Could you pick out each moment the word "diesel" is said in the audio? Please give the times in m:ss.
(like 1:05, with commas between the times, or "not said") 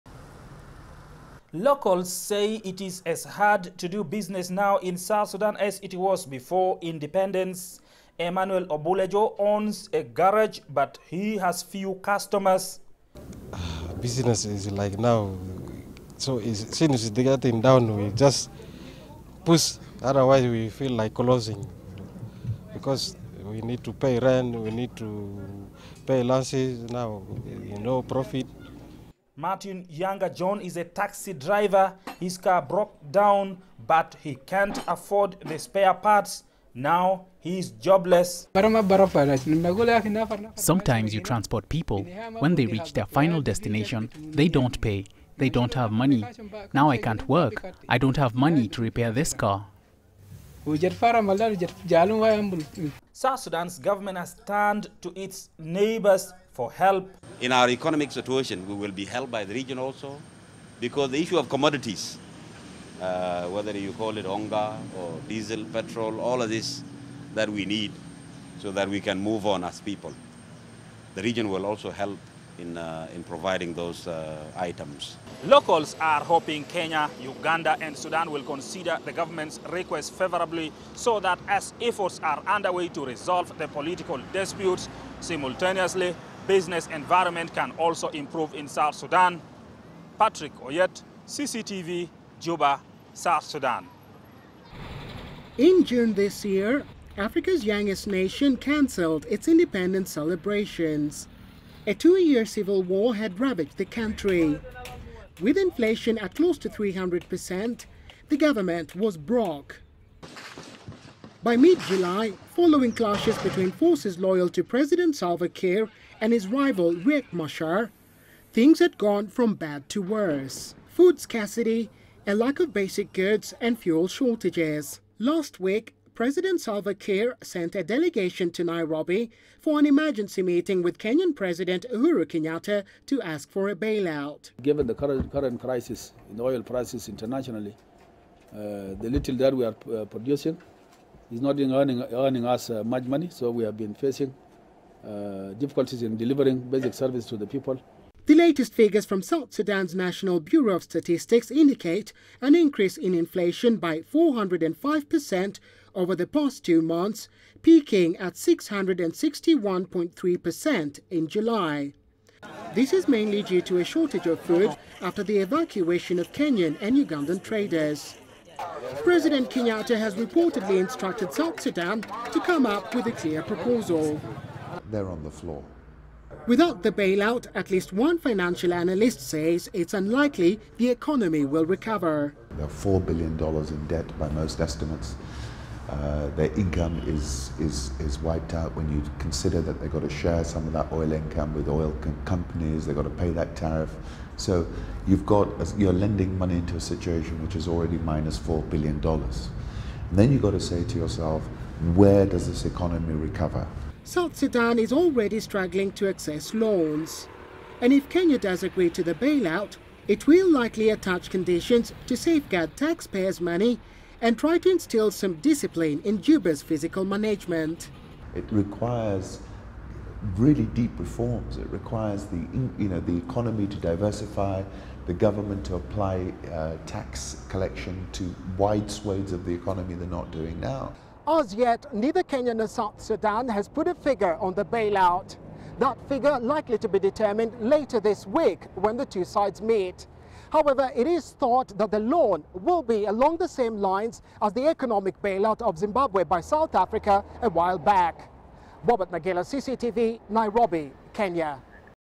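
1:05.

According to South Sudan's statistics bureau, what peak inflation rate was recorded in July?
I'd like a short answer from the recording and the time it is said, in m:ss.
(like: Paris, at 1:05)
661.3%, at 2:38.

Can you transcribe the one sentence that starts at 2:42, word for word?
This is mainly due to a shortage of food after the evacuation of Kenyan and Ugandan traders.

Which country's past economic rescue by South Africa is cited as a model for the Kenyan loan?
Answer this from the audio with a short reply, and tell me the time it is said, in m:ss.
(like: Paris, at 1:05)
Zimbabwe, at 4:05.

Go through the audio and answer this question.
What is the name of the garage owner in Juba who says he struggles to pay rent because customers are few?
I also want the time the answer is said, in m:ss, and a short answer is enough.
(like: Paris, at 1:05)
Emmanuel Obulejo, at 0:08.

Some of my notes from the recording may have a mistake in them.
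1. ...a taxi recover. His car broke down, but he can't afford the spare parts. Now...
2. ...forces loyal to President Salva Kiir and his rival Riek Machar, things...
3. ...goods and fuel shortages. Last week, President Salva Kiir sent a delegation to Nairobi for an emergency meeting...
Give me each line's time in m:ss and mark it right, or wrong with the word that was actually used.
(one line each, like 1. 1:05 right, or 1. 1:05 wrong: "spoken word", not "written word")
1. 0:30 wrong: "driver", not "recover"
2. 1:53 right
3. 2:03 right.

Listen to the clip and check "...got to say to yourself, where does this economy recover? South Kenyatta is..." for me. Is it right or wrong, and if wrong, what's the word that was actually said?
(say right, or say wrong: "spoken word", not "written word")
wrong: "Sudan", not "Kenyatta".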